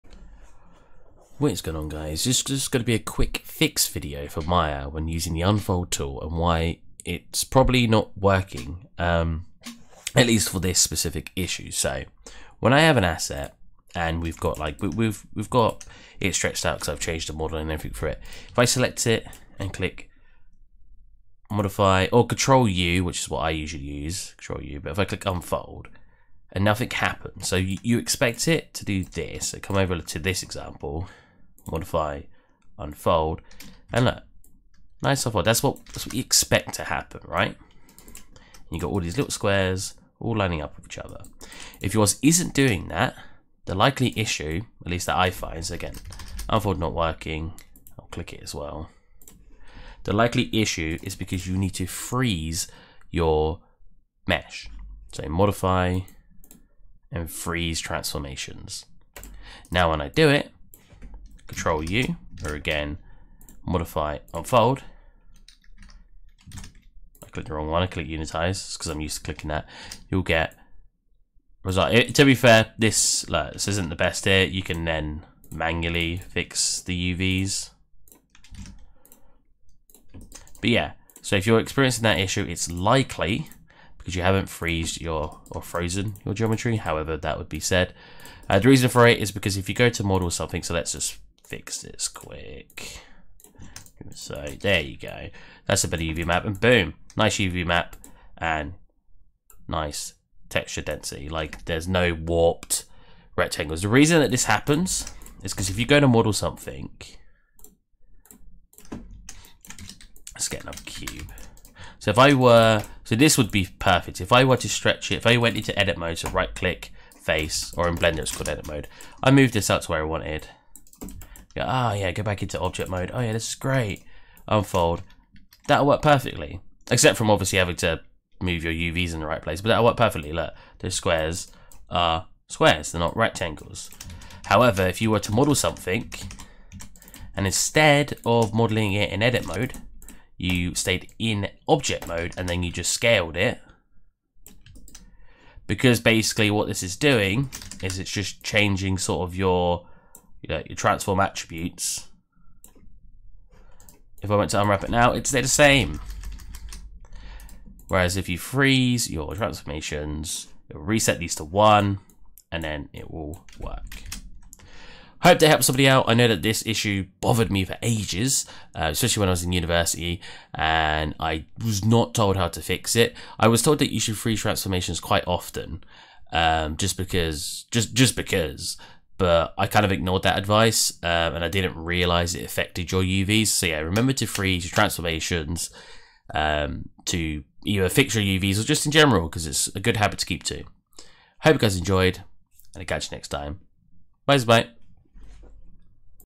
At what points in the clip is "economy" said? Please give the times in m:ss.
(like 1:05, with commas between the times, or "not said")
not said.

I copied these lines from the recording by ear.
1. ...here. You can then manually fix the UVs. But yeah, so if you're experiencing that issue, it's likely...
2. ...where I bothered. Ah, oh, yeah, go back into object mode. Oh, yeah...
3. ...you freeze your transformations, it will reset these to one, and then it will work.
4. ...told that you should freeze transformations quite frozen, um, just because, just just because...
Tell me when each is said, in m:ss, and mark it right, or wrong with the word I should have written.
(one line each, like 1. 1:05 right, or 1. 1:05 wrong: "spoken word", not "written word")
1. 1:14 right
2. 1:59 wrong: "wanted", not "bothered"
3. 2:38 right
4. 2:53 wrong: "often", not "frozen".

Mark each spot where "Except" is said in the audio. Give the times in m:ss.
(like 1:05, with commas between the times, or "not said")
2:06.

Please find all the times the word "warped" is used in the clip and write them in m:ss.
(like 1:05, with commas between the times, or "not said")
1:42.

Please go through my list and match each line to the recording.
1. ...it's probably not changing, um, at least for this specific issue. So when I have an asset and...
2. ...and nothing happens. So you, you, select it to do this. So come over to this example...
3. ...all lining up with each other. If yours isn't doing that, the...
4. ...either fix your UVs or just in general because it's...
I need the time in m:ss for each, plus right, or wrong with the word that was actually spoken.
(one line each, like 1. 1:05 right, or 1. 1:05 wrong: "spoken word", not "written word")
1. 0:07 wrong: "working", not "changing"
2. 0:26 wrong: "expect", not "select"
3. 0:40 right
4. 3:07 right.